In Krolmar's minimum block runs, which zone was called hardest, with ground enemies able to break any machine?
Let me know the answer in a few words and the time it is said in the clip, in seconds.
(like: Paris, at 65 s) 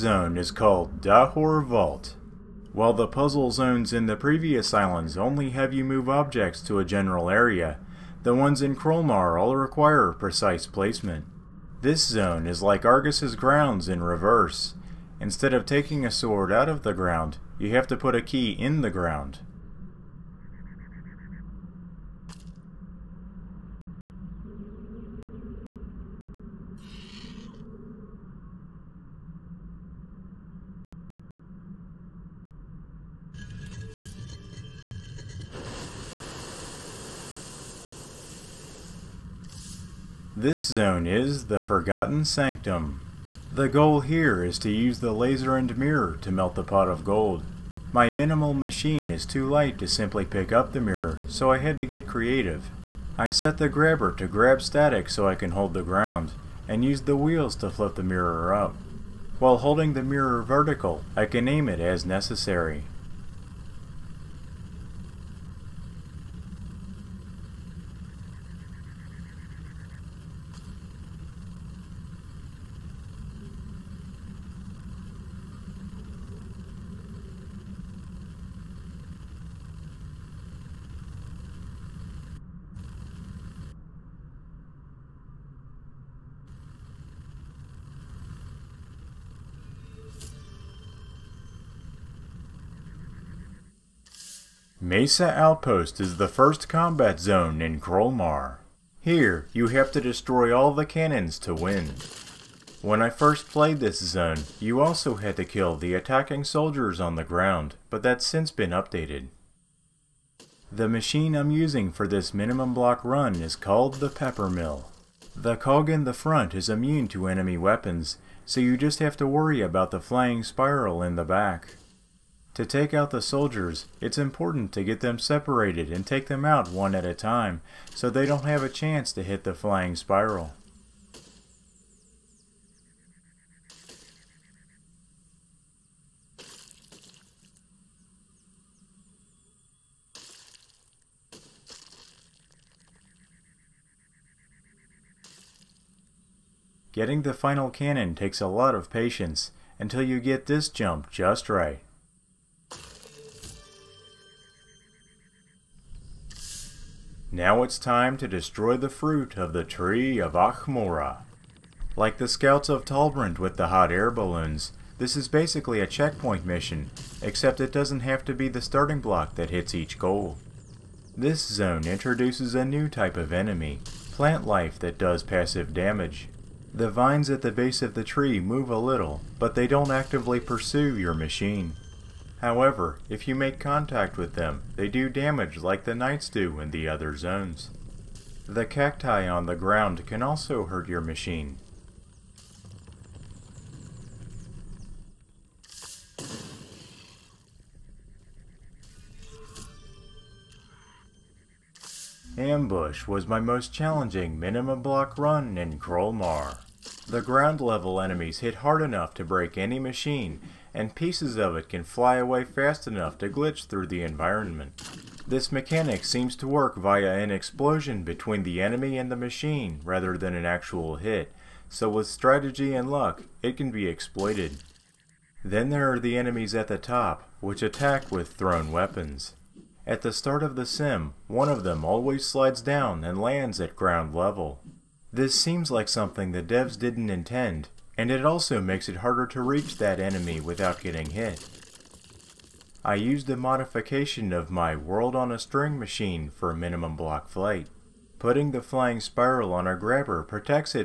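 Ambush, at 202 s.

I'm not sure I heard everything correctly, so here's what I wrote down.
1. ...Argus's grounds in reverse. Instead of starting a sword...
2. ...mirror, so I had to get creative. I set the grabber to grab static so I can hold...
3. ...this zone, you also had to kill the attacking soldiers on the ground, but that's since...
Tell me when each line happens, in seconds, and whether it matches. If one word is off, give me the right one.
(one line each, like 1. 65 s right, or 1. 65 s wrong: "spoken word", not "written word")
1. 12 s wrong: "taking", not "starting"
2. 50 s right
3. 103 s right.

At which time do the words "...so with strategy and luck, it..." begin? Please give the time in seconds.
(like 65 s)
221 s.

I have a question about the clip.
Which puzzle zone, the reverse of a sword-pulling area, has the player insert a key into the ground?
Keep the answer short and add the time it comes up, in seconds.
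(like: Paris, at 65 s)
Dahor Vault, at 1 s.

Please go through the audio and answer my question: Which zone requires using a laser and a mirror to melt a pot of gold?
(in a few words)
Forgotten Sanctum.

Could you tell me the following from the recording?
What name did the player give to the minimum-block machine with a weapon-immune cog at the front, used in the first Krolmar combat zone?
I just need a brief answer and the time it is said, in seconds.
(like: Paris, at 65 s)
Pepper Mill, at 114 s.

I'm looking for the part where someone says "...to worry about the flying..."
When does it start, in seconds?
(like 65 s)
119 s.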